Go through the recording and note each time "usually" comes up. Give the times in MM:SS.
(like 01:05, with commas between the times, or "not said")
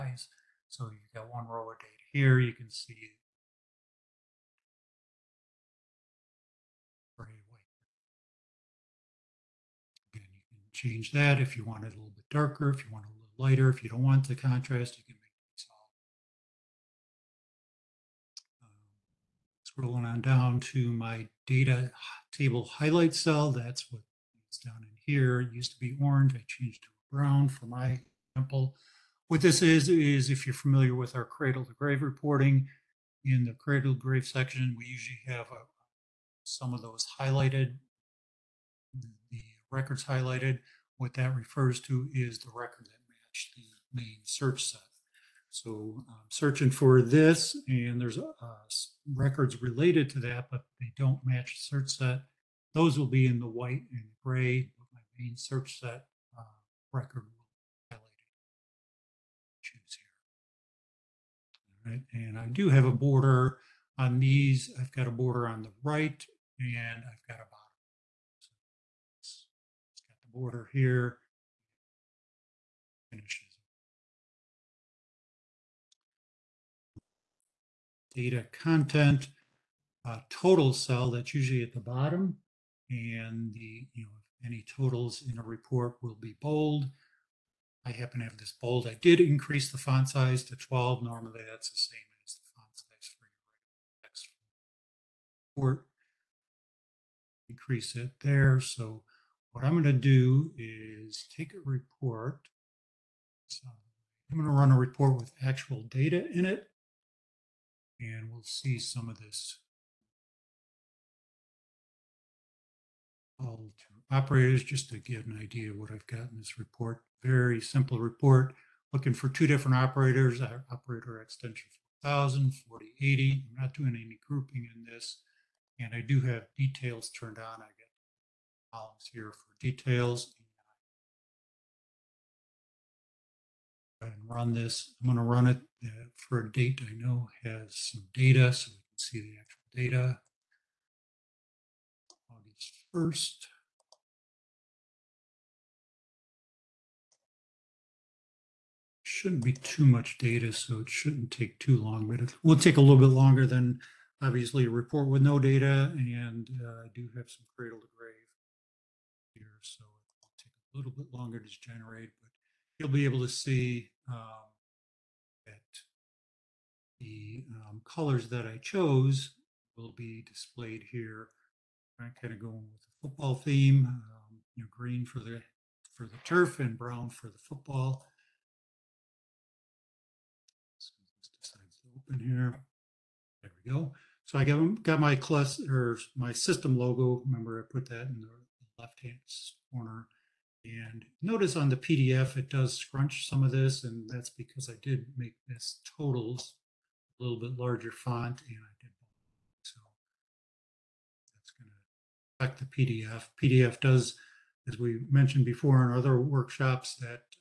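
00:34, 01:21.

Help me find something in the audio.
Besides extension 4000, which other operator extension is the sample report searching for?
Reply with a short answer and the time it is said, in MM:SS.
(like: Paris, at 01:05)
4080, at 02:02.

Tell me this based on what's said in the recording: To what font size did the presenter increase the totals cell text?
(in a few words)
12.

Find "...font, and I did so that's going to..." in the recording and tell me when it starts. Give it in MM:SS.
03:17.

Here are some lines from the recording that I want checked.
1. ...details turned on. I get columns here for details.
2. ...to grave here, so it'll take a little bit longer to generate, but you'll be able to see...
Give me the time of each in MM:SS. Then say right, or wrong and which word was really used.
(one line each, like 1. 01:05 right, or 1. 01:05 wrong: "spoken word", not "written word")
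1. 02:06 right
2. 02:37 right.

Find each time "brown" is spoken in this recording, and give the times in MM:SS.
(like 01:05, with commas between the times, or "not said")
00:27, 02:56.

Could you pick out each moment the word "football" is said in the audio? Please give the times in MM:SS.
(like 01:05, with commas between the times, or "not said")
02:53, 02:57.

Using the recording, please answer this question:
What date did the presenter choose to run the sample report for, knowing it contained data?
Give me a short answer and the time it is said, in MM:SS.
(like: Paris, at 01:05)
August 1st, at 02:22.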